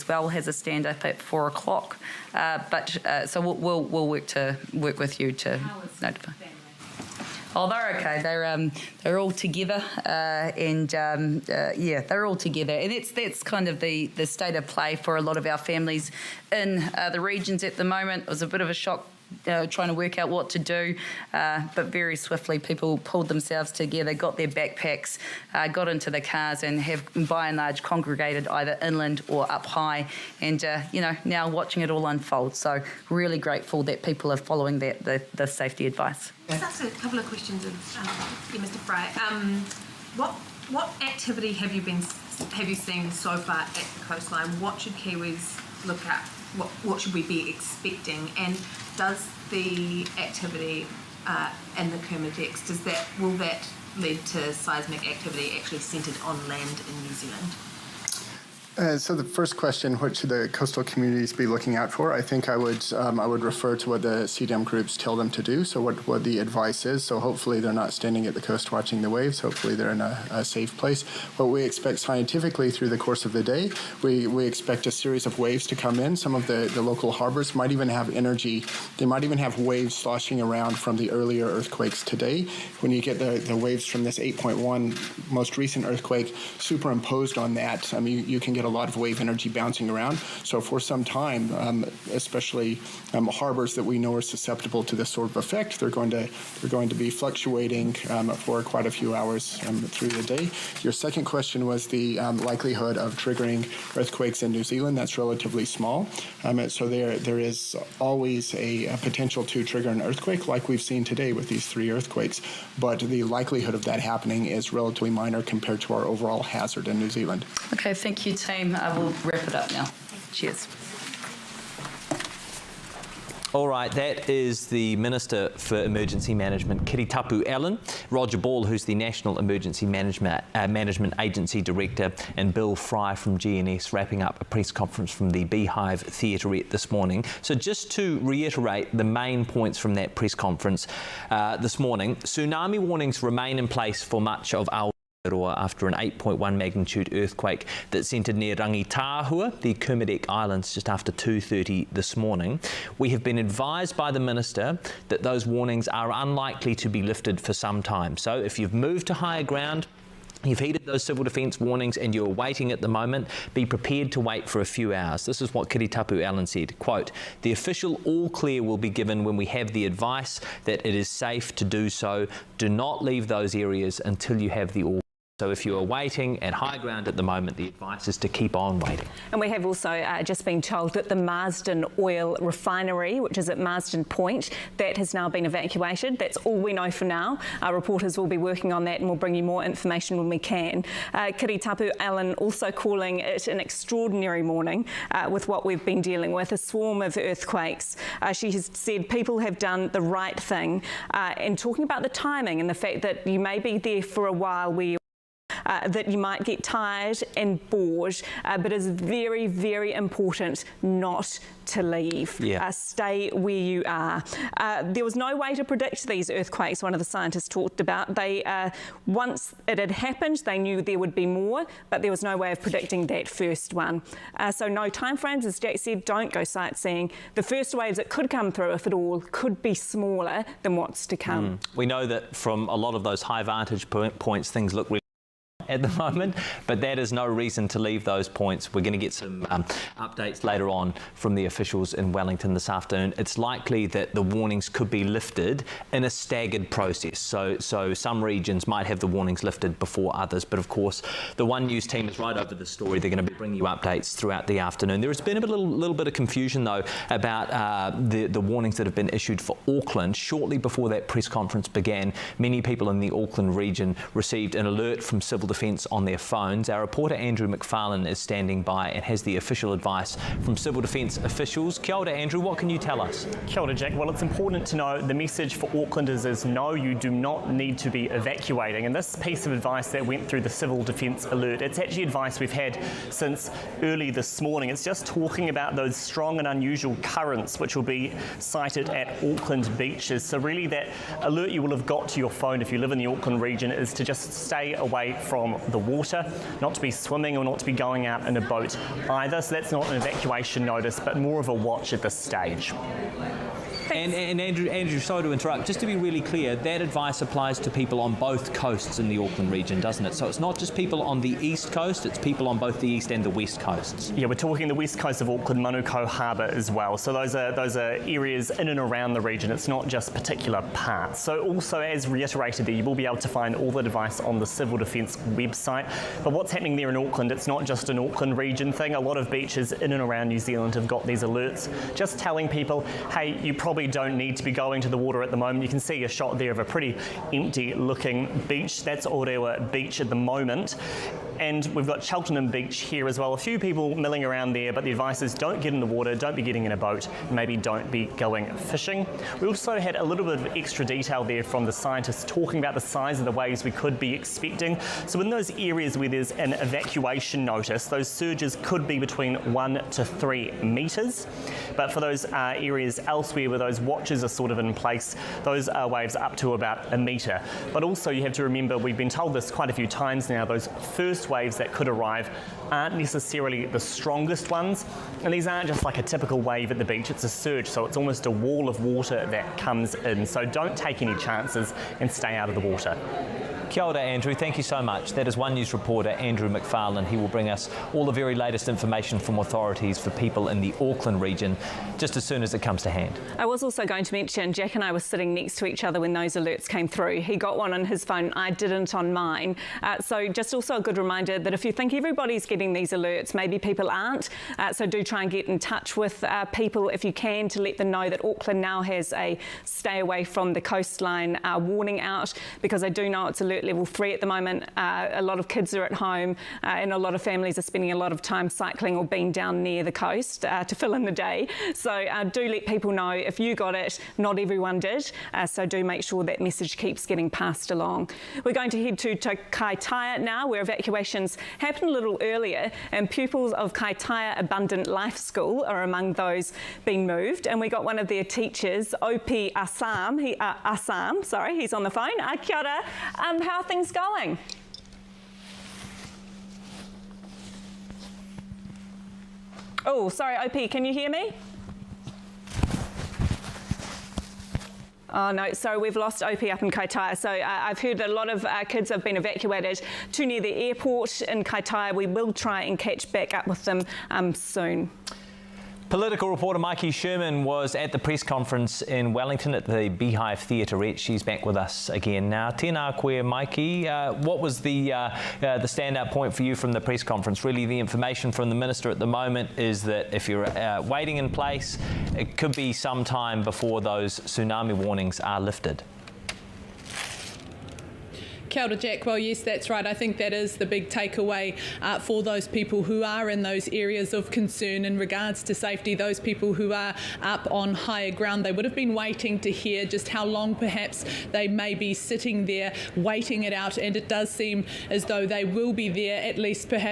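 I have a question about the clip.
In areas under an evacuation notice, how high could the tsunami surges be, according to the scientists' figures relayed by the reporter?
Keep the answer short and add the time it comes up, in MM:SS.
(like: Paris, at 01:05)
1 to 3 metres, at 05:59.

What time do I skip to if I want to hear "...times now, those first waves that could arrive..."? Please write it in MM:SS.
06:09.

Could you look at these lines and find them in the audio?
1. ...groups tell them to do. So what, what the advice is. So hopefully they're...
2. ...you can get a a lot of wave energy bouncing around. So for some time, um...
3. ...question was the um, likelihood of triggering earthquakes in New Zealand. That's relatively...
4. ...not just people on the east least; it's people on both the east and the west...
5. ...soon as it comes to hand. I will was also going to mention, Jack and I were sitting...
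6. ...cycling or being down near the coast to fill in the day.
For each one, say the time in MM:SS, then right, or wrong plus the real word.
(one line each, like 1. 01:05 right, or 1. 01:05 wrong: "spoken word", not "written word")
1. 01:04 right
2. 01:28 right
3. 01:41 right
4. 05:10 wrong: "coast", not "least"
5. 06:32 right
6. 06:58 right.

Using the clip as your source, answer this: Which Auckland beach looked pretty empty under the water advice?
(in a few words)
Orewa Beach.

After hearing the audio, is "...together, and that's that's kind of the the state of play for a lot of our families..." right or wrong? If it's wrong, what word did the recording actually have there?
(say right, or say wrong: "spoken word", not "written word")
right.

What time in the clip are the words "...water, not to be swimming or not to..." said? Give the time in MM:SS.
04:55.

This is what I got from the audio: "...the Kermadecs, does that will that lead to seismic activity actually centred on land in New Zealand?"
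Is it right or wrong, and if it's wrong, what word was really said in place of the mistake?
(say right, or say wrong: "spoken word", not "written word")
right.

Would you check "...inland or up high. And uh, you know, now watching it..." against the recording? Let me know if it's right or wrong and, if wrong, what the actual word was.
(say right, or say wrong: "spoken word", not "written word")
right.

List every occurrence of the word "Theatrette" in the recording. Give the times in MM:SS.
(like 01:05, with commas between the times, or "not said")
02:16, 07:50.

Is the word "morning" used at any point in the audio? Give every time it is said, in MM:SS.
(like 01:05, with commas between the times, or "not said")
02:16, 02:21, 02:32, 03:14, 04:44.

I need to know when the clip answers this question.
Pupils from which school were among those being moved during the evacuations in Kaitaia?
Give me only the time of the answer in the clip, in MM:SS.
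07:13.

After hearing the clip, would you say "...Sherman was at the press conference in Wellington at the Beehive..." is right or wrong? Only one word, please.
right.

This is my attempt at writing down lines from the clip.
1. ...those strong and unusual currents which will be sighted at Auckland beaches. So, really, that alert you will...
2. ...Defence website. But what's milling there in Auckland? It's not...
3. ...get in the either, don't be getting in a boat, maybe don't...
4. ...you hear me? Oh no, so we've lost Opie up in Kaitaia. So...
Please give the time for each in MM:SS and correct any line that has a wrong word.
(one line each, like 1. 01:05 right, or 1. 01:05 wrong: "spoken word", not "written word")
1. 04:45 right
2. 05:24 wrong: "happening", not "milling"
3. 05:45 wrong: "water", not "either"
4. 07:30 right.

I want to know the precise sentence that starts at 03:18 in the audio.
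Uh, she has said people have done the right thing.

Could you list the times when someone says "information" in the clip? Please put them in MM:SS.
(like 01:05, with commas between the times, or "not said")
03:09, 06:28, 07:57.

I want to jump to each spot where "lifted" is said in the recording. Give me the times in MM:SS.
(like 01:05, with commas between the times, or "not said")
02:37, 04:05, 04:09, 08:05.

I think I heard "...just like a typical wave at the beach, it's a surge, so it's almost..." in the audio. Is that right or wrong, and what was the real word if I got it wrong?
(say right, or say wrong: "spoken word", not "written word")
right.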